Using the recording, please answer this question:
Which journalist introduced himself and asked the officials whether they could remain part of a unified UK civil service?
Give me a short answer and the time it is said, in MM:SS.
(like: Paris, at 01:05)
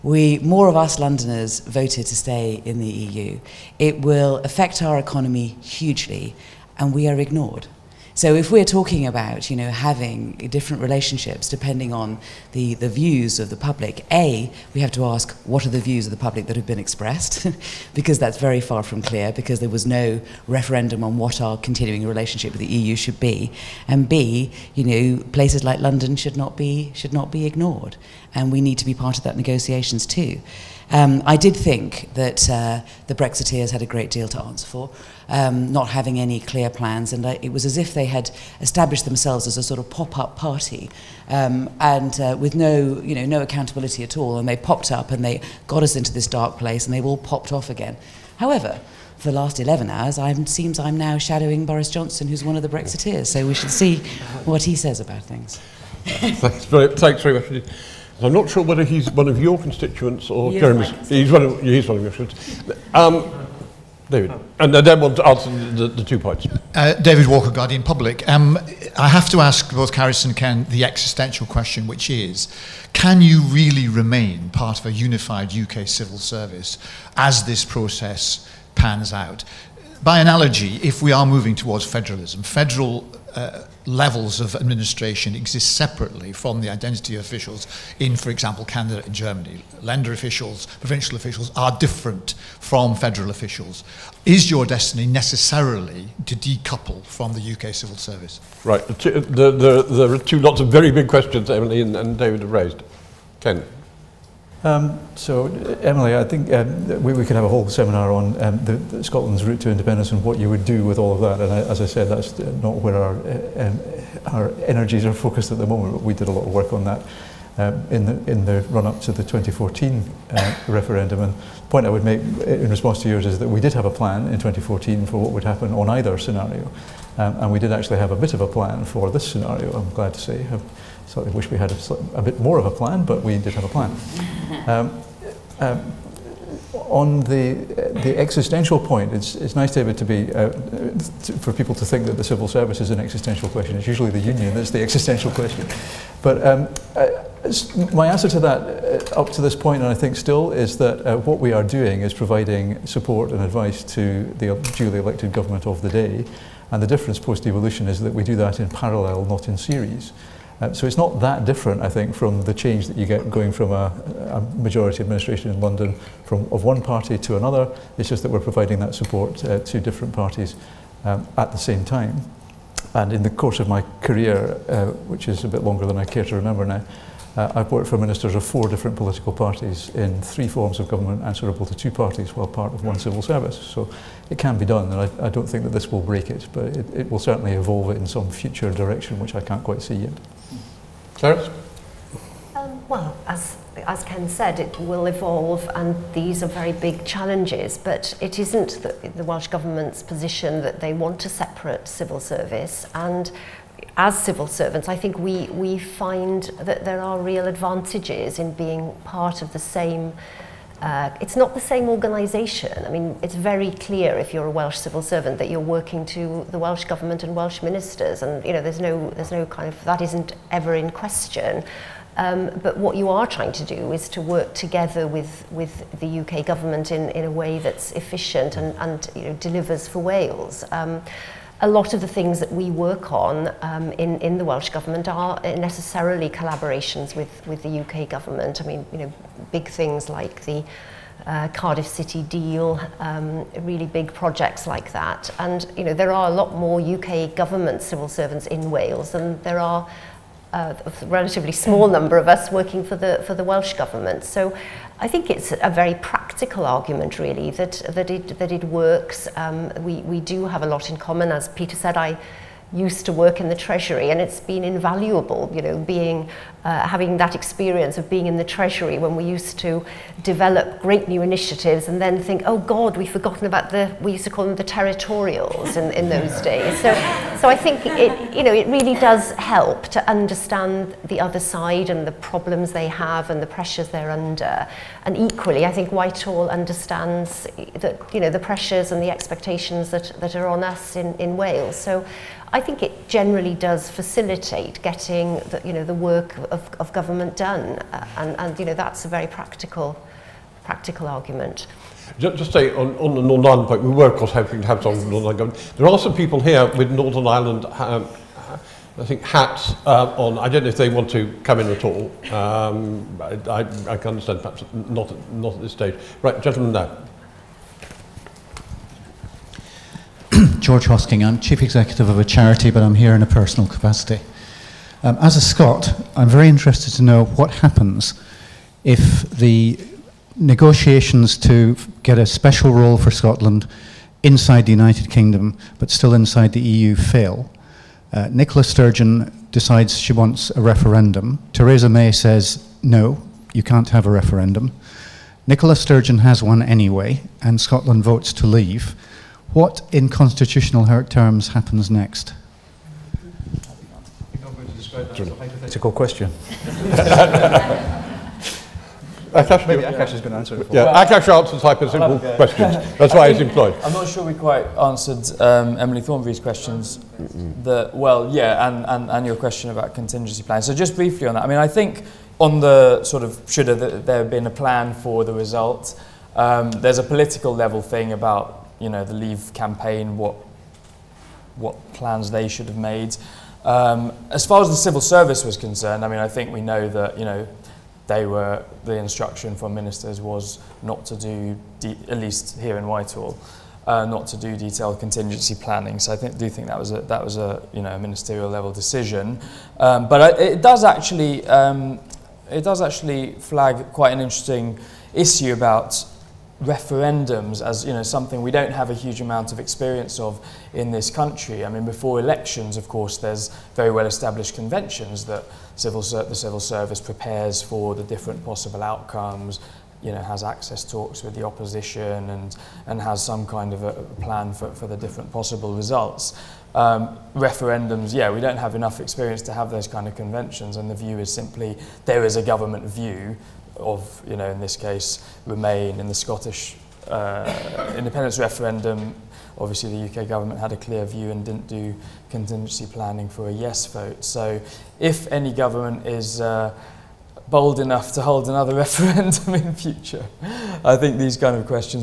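David Walker, at 01:06.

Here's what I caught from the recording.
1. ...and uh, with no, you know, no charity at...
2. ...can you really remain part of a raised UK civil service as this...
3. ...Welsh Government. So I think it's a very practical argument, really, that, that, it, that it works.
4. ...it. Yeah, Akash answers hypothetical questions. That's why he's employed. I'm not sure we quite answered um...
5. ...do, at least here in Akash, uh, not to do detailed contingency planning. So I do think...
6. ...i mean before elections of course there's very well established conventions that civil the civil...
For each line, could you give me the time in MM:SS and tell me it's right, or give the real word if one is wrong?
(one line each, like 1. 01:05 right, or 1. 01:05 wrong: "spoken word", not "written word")
1. 00:41 wrong: "accountability", not "charity"
2. 01:12 wrong: "unified", not "raised"
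3. 04:13 right
4. 06:00 right
5. 06:31 wrong: "Whitehall", not "Akash"
6. 06:51 right.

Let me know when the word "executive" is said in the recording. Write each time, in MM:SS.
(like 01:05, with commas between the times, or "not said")
05:21.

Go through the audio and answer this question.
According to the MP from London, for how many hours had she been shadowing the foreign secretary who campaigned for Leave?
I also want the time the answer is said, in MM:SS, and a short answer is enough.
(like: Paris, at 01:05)
11, at 00:49.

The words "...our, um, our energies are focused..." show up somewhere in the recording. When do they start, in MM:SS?
01:52.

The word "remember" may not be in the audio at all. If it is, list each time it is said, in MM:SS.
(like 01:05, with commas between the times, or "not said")
02:56.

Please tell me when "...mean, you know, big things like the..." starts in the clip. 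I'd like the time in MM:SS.
03:58.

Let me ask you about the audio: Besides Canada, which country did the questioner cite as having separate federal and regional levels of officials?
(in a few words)
Germany.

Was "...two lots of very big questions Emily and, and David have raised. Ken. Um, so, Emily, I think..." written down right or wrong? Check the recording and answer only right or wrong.
right.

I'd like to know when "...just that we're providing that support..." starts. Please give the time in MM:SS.
02:48.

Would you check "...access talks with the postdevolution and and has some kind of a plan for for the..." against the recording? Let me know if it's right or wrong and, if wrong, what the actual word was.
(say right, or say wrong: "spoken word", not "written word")
wrong: "opposition", not "postdevolution".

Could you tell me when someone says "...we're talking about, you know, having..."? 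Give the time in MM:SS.
00:08.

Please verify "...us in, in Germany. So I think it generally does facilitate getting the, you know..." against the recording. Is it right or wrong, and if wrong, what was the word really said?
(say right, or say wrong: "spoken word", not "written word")
wrong: "Wales", not "Germany".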